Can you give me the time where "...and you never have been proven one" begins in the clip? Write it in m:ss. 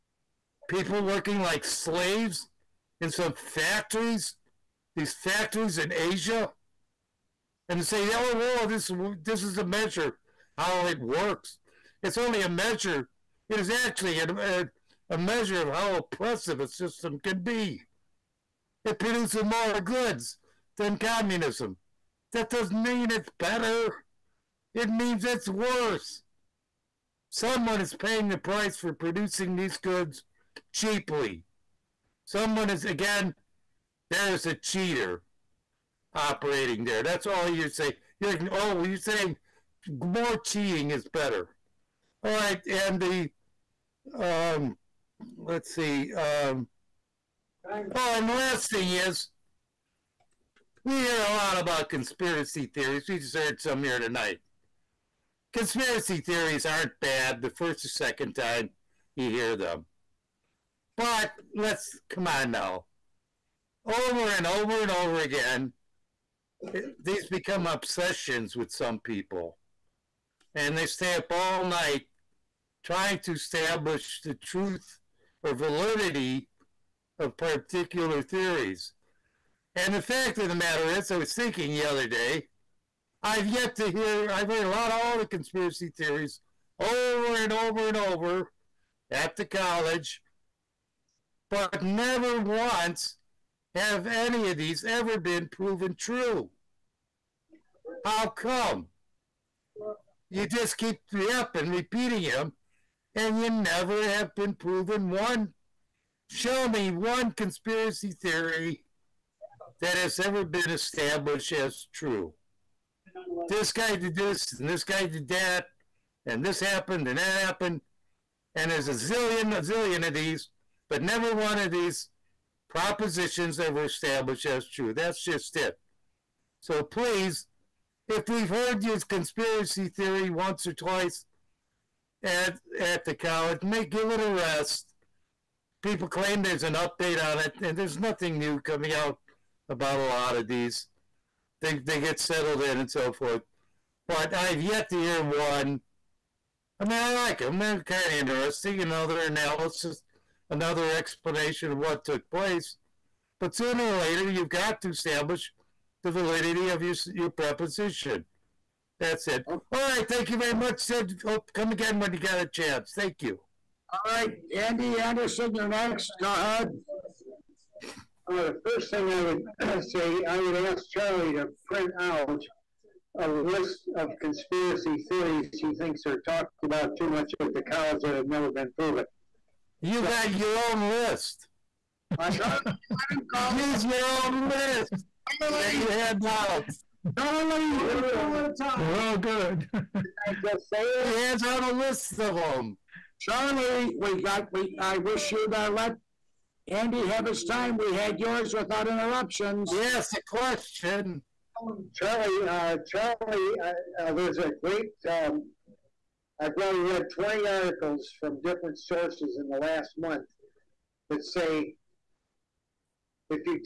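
1:43.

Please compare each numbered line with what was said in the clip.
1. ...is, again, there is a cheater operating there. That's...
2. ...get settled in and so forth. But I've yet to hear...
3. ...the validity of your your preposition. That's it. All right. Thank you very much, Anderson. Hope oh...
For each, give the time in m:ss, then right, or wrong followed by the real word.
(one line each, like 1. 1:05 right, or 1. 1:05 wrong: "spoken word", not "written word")
1. 0:32 right
2. 2:21 right
3. 2:36 wrong: "Sid", not "Anderson".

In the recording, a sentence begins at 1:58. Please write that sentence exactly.
And there's a zillion, a zillion of these, but never one of these propositions ever established as true.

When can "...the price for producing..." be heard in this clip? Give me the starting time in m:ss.
0:28.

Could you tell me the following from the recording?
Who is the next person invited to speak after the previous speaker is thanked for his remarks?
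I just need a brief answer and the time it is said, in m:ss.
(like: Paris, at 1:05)
Andy Anderson, at 2:44.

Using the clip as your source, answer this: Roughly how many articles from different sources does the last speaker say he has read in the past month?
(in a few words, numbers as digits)
20.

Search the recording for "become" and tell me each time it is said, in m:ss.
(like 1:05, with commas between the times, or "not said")
1:07.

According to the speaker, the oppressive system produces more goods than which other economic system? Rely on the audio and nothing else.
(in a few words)
communism.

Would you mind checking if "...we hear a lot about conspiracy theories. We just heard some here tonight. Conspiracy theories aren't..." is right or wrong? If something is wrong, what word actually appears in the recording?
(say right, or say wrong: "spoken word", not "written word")
right.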